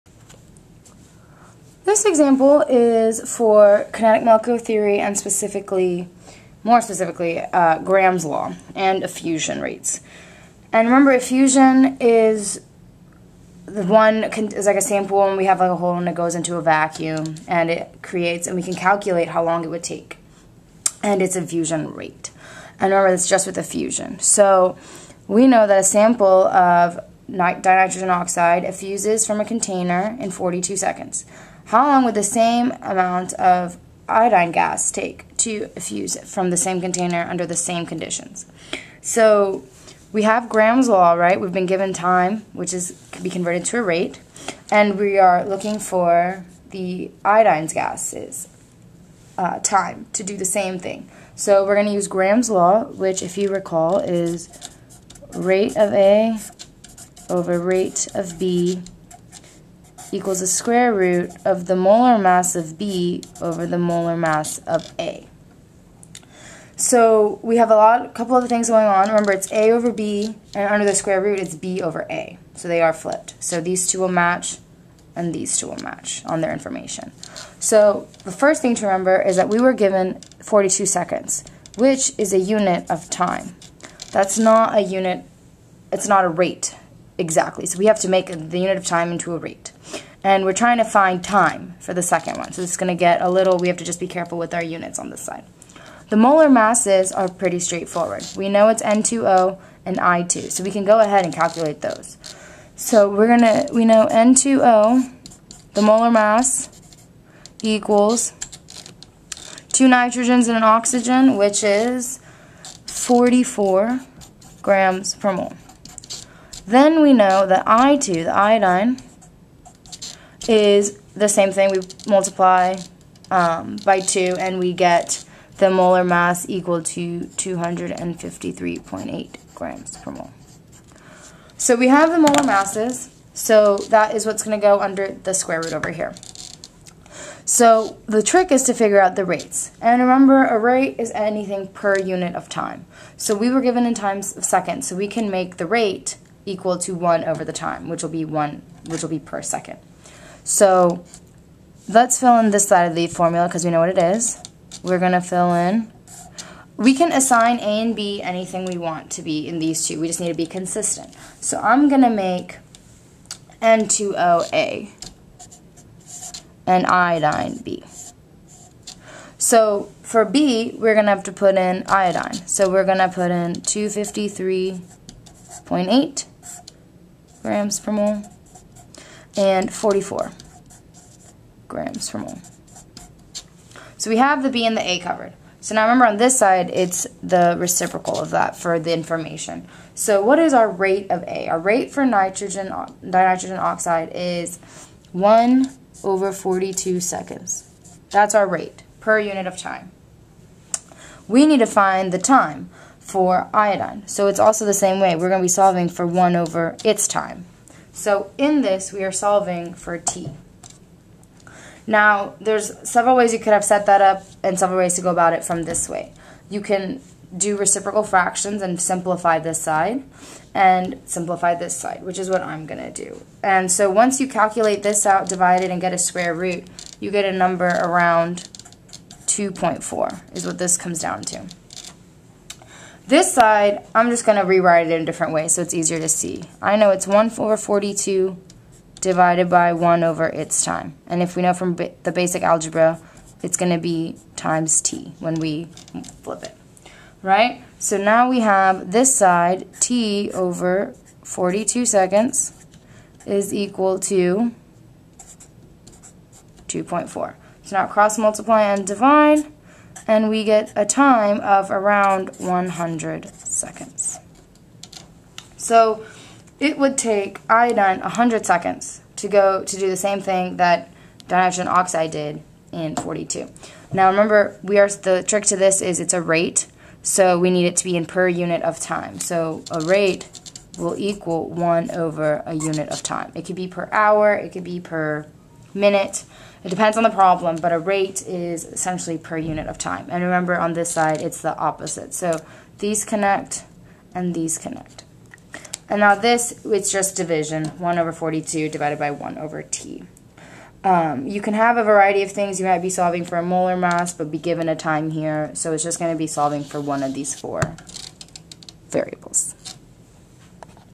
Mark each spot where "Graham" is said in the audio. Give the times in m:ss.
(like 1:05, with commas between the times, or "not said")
0:07, 0:40, 0:52.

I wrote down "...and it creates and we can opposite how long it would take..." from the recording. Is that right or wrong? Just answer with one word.
wrong.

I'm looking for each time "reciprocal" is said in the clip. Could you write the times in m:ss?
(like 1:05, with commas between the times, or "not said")
3:07, 3:37.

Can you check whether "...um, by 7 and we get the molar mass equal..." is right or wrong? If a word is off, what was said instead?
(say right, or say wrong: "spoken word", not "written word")
wrong: "2", not "7".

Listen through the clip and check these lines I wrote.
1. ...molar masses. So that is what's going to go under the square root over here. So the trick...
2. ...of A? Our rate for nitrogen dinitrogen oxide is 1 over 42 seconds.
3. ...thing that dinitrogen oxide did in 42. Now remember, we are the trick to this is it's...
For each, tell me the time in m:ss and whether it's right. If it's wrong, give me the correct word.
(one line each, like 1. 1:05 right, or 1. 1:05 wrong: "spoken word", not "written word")
1. 2:12 right
2. 3:11 right
3. 4:30 right.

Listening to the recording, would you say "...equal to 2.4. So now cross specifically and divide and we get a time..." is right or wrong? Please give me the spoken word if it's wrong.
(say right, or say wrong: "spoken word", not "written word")
wrong: "multiply", not "specifically".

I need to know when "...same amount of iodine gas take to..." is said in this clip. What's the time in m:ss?
0:32.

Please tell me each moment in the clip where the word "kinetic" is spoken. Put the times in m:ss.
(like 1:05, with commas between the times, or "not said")
0:03.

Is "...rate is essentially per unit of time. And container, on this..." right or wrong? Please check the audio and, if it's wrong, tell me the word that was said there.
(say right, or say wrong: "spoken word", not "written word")
wrong: "remember", not "container".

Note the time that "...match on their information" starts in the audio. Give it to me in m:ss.
1:15.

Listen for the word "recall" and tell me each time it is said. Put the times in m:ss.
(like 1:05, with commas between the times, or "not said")
0:53.